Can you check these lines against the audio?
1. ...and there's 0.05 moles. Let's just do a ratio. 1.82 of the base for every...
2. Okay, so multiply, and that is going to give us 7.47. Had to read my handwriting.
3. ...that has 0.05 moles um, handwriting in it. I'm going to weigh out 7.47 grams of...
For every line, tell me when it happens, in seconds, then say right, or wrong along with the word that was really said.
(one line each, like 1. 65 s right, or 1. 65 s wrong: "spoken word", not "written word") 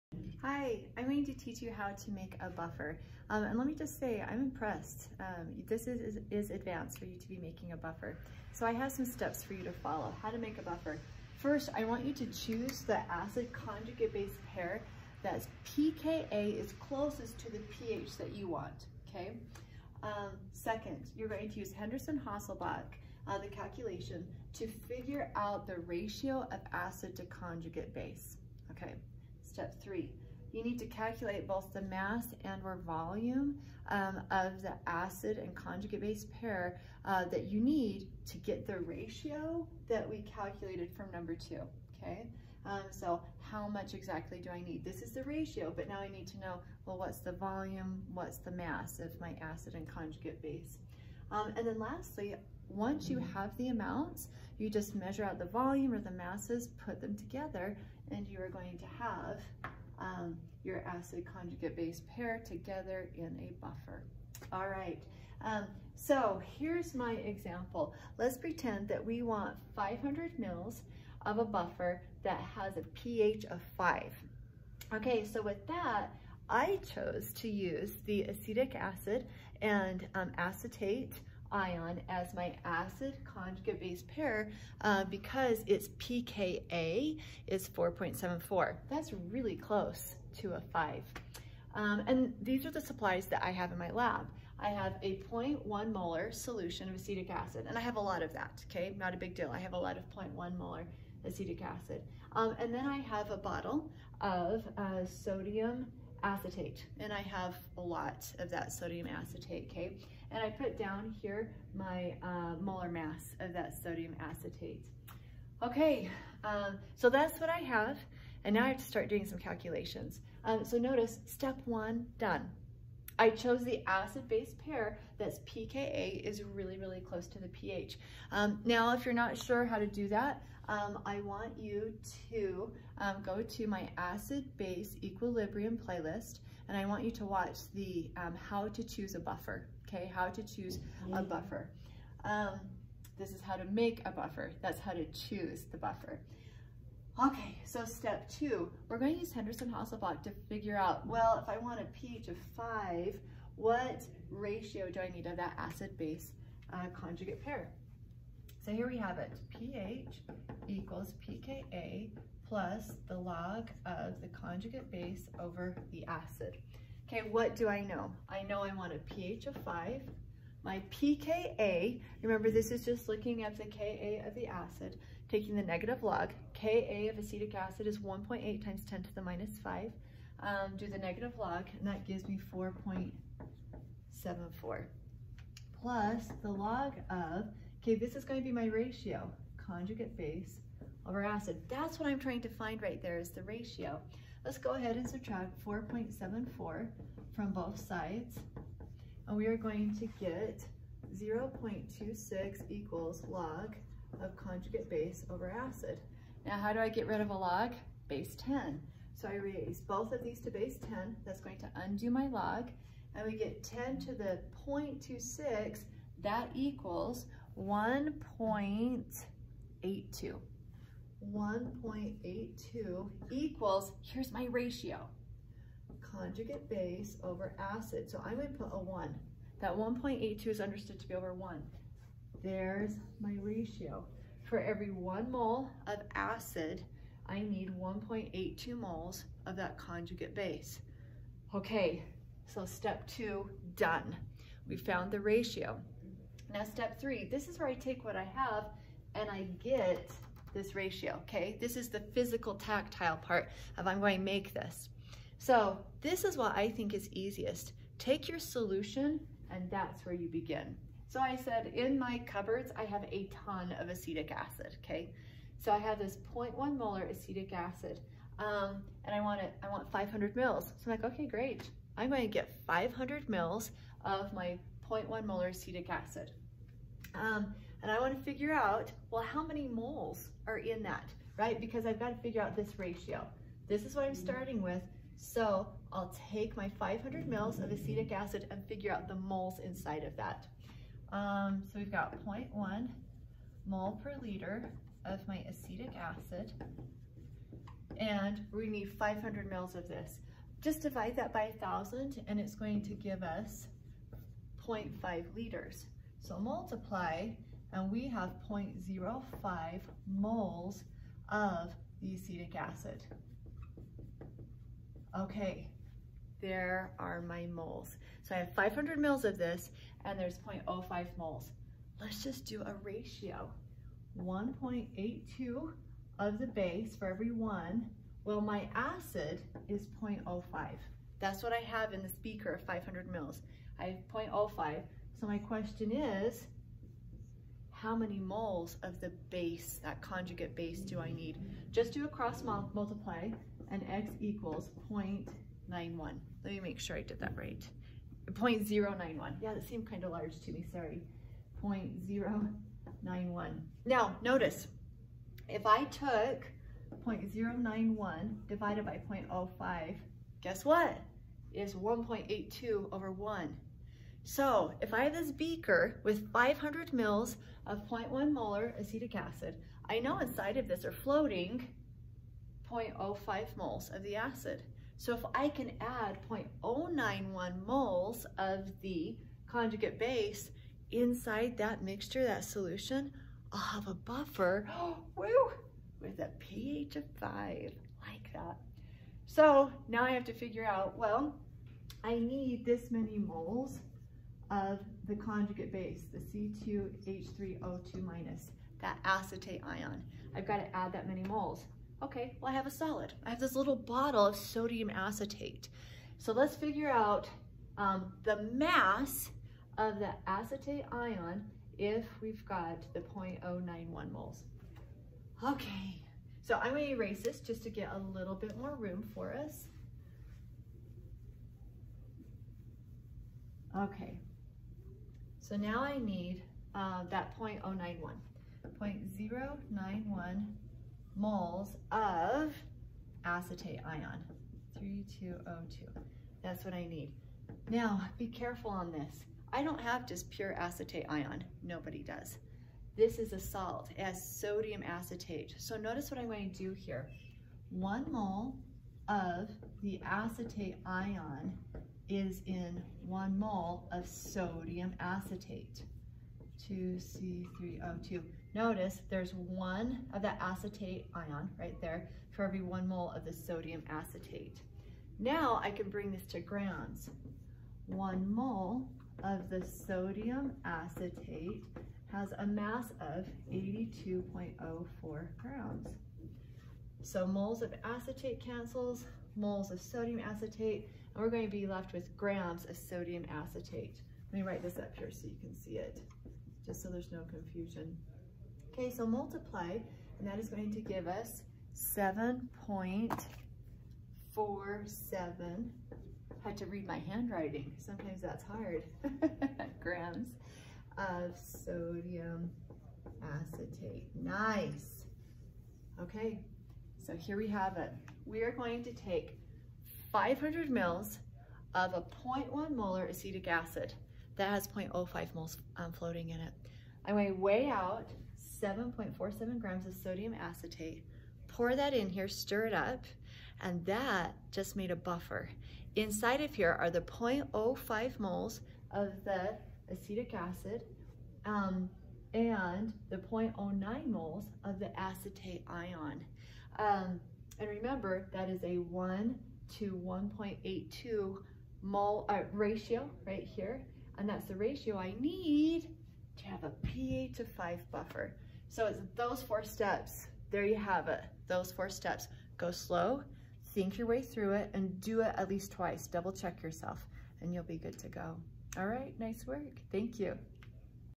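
1. 320 s right
2. 488 s right
3. 514 s wrong: "floating", not "handwriting".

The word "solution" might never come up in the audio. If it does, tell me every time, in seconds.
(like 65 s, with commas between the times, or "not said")
96 s, 258 s, 382 s.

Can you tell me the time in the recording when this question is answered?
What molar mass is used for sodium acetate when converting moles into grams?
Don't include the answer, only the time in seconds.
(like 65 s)
473 s.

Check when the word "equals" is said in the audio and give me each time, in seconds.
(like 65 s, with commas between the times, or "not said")
160 s, 202 s, 216 s, 223 s, 344 s.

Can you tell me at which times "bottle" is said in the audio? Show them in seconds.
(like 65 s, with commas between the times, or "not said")
103 s, 403 s.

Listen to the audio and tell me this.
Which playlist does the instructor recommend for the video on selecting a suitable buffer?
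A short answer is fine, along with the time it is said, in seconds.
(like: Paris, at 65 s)
acid base equilibrium playlist, at 133 s.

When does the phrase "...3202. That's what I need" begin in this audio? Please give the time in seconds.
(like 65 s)
434 s.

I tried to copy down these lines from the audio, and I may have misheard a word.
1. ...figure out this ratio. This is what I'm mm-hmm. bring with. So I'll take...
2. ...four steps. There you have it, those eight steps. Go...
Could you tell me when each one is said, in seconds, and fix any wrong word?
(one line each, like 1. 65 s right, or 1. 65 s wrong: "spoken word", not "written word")
1. 282 s wrong: "starting", not "bring"
2. 549 s wrong: "four", not "eight".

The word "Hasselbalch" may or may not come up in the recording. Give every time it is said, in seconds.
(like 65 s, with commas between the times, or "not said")
21 s, 149 s.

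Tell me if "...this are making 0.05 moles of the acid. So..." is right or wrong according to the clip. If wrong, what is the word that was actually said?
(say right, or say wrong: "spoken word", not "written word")
wrong: "floating", not "making".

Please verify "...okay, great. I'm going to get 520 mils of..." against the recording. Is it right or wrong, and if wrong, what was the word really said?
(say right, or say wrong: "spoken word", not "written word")
wrong: "500", not "520".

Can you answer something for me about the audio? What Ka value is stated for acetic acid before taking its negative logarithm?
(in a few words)
1.8 x 10^-5.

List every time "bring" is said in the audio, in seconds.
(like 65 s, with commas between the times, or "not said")
465 s.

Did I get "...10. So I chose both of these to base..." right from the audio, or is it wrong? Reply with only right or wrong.
wrong.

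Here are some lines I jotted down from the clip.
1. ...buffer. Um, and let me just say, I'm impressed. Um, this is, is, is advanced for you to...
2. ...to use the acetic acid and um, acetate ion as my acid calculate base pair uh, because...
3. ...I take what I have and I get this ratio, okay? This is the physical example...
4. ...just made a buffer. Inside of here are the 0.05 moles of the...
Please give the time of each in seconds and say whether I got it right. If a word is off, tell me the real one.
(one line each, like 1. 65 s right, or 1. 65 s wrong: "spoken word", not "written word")
1. 2 s right
2. 77 s wrong: "conjugate", not "calculate"
3. 247 s wrong: "tactile", not "example"
4. 524 s right.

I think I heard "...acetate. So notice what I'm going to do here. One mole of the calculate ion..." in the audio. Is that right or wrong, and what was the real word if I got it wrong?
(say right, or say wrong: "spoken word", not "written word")
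wrong: "acetate", not "calculate".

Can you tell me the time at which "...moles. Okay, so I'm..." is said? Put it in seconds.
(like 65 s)
414 s.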